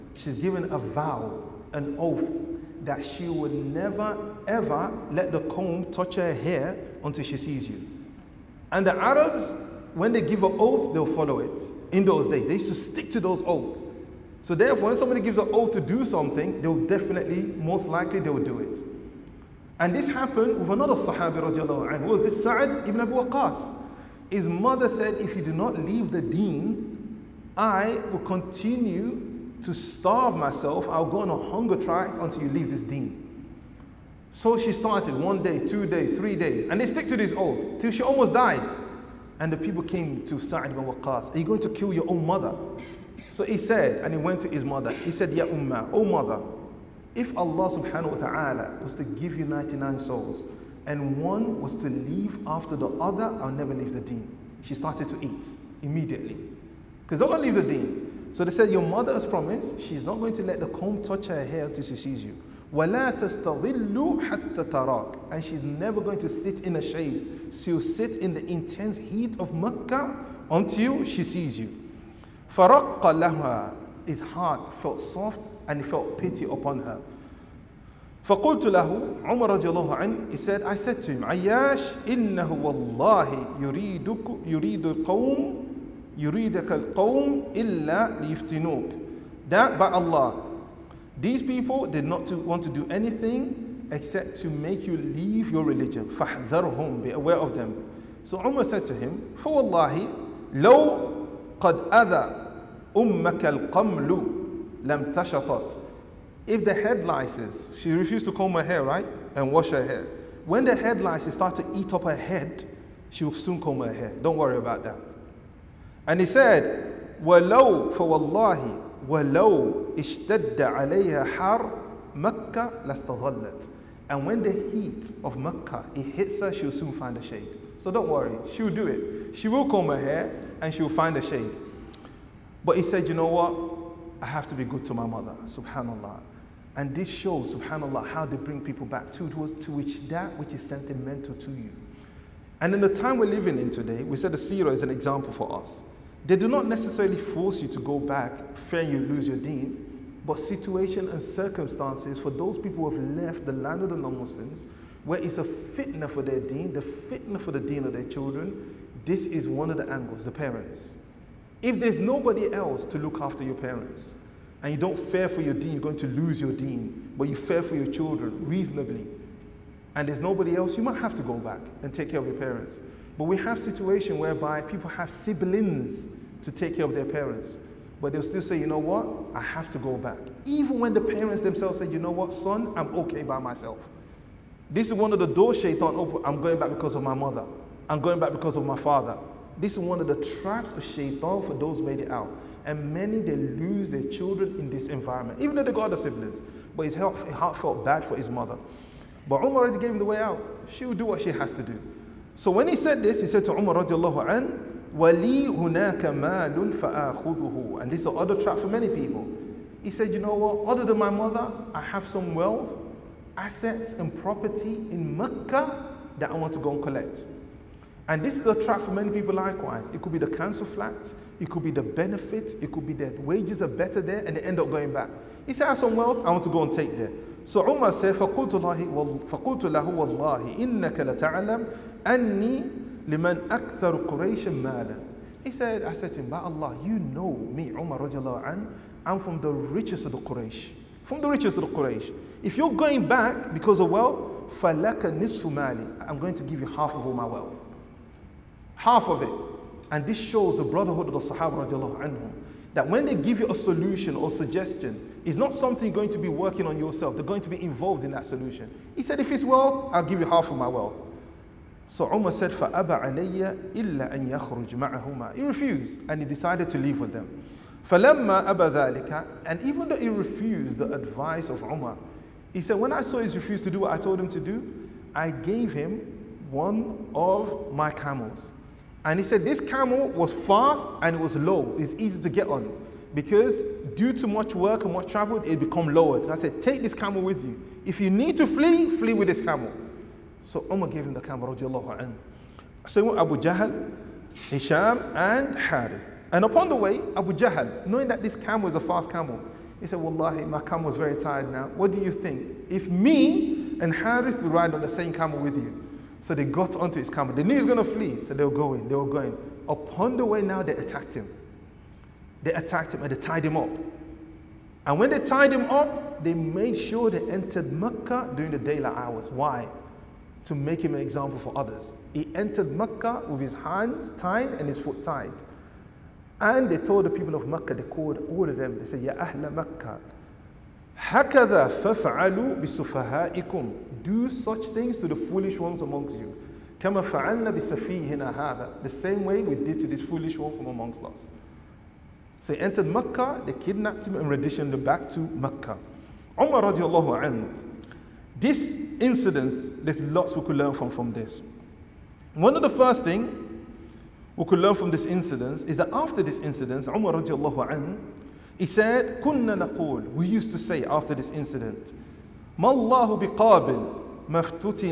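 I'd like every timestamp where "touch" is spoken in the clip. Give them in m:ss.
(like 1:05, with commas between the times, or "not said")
0:05, 1:01.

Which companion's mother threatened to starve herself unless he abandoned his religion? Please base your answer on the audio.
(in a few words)
Sa'ad ibn Abu Waqas.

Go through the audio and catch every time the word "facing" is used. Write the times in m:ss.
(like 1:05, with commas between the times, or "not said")
not said.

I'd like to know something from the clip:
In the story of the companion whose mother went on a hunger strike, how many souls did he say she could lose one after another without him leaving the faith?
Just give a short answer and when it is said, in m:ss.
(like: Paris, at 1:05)
99, at 0:49.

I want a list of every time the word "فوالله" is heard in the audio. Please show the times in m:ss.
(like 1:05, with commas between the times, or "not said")
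1:39, 1:57.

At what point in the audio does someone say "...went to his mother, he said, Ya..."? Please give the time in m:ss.
0:44.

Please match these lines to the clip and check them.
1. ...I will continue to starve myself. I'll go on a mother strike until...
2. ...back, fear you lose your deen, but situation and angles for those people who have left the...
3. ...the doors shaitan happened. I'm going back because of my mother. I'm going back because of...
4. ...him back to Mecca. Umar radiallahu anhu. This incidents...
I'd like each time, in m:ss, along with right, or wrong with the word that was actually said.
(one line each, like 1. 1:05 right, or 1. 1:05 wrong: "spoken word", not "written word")
1. 0:27 wrong: "hunger", not "mother"
2. 2:27 wrong: "circumstances", not "angles"
3. 3:05 wrong: "opened", not "happened"
4. 5:44 right.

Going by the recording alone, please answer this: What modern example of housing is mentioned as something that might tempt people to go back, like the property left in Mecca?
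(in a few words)
Council flat.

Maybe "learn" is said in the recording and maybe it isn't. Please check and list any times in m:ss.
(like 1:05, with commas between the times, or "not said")
5:50, 5:54.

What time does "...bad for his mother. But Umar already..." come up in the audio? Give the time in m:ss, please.
3:17.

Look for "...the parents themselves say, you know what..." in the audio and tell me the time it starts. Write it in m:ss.
3:00.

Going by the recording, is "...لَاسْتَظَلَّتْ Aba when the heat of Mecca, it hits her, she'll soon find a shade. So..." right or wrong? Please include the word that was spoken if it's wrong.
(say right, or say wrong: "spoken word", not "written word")
wrong: "And", not "Aba".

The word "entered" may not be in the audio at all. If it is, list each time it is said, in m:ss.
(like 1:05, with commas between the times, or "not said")
5:17, 5:22, 5:42.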